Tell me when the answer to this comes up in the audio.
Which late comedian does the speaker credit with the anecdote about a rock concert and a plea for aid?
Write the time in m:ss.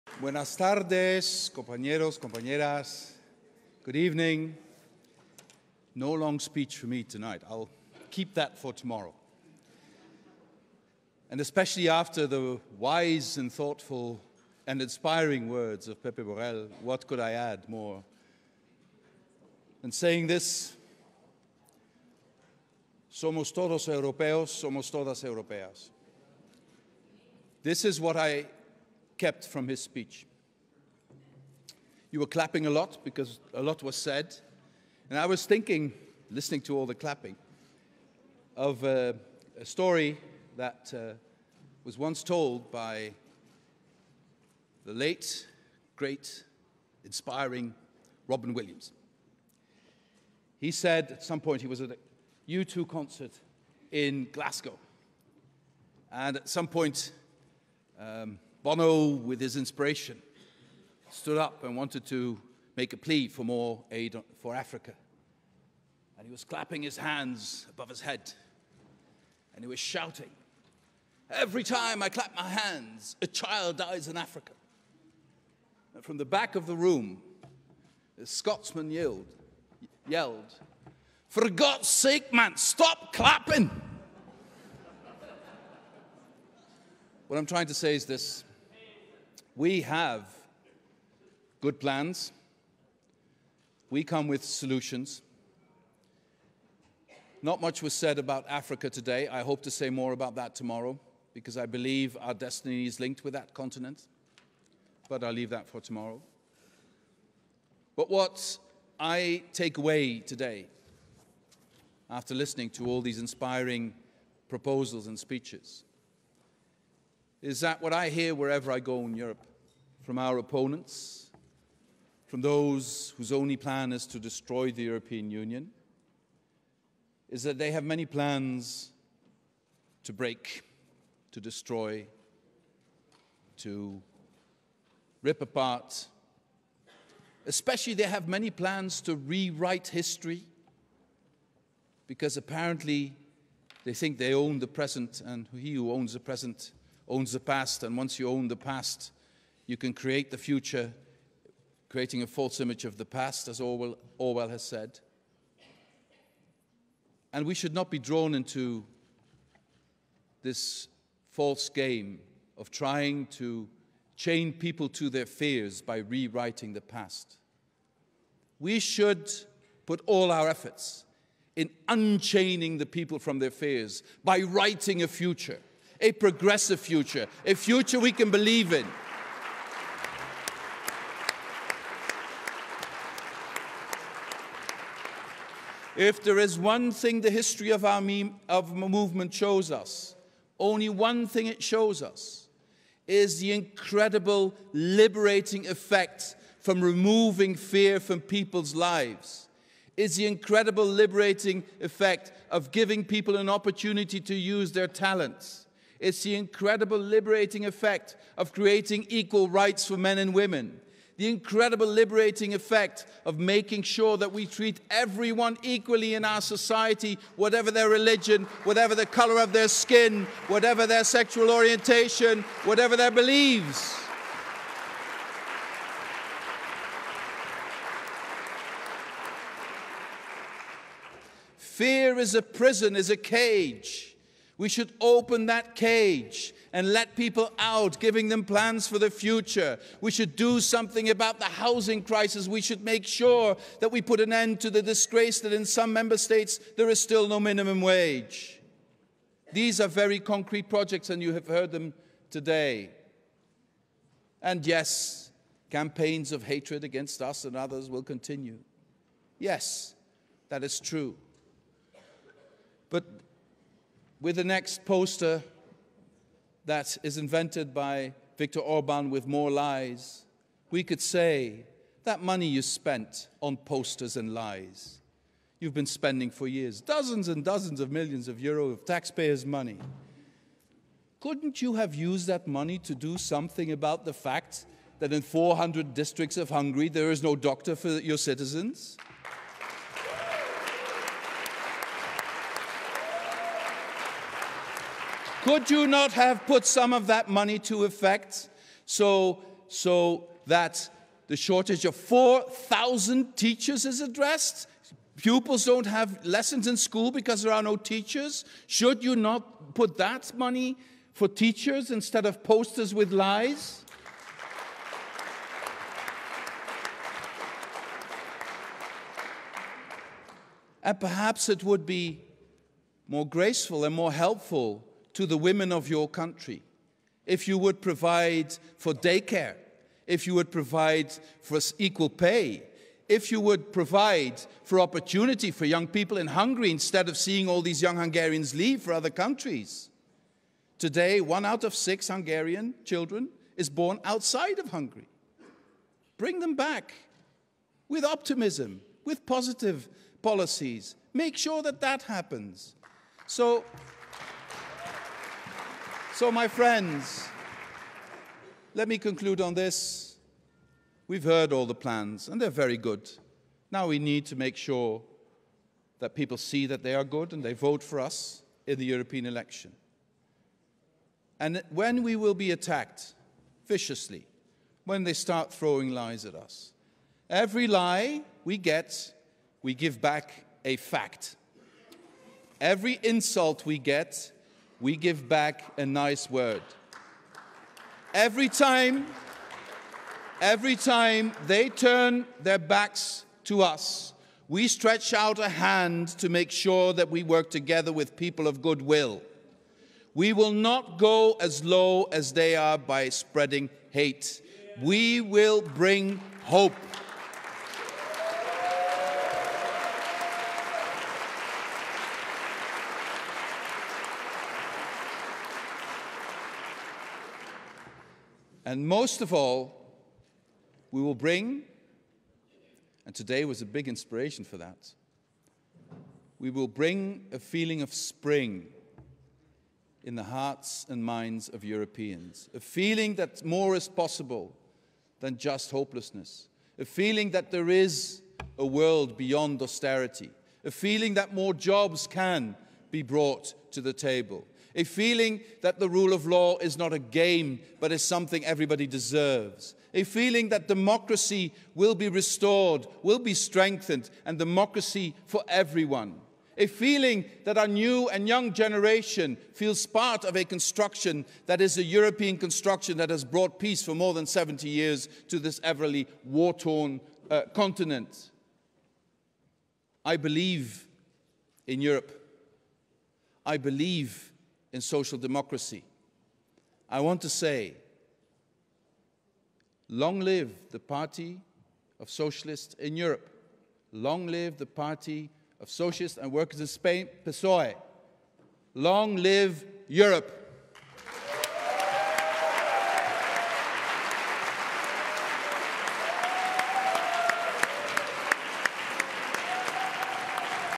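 0:48.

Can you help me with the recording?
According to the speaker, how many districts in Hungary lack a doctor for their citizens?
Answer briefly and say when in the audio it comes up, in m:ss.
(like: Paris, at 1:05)
400, at 4:45.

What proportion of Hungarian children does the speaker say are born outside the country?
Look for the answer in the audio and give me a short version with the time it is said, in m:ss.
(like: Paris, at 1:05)
one out of six, at 5:41.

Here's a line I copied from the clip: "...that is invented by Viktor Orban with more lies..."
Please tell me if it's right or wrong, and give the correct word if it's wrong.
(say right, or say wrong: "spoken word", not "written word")
right.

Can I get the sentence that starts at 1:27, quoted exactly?
what I'm trying to say is this we have good plans.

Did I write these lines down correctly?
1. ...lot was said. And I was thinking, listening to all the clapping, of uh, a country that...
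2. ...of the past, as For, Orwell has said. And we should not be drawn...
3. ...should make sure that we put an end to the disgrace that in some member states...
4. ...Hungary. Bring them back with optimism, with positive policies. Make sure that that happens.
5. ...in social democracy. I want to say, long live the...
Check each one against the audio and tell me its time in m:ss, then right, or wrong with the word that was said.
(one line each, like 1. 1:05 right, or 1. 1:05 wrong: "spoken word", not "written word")
1. 0:33 wrong: "story", not "country"
2. 2:32 wrong: "Orwell", not "For"
3. 4:02 right
4. 5:44 right
5. 7:54 right.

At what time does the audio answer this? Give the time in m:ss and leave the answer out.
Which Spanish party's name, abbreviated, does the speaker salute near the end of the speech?
8:07.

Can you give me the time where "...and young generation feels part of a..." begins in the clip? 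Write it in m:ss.
7:38.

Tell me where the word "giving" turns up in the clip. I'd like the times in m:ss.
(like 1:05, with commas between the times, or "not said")
3:22, 3:57.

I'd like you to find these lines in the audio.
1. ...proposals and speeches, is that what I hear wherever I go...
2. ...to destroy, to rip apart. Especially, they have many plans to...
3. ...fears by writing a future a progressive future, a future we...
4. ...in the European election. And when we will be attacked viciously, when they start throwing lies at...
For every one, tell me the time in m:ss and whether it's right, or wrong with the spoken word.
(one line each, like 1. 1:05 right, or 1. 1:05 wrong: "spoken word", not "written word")
1. 1:54 right
2. 2:11 right
3. 2:53 right
4. 6:08 right.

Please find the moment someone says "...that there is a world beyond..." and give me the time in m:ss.
7:17.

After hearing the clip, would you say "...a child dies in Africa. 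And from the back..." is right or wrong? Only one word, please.
right.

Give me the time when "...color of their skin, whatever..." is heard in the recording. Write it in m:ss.
3:39.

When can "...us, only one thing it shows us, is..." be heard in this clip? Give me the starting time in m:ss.
3:09.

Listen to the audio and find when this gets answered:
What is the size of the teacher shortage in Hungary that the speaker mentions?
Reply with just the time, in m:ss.
5:01.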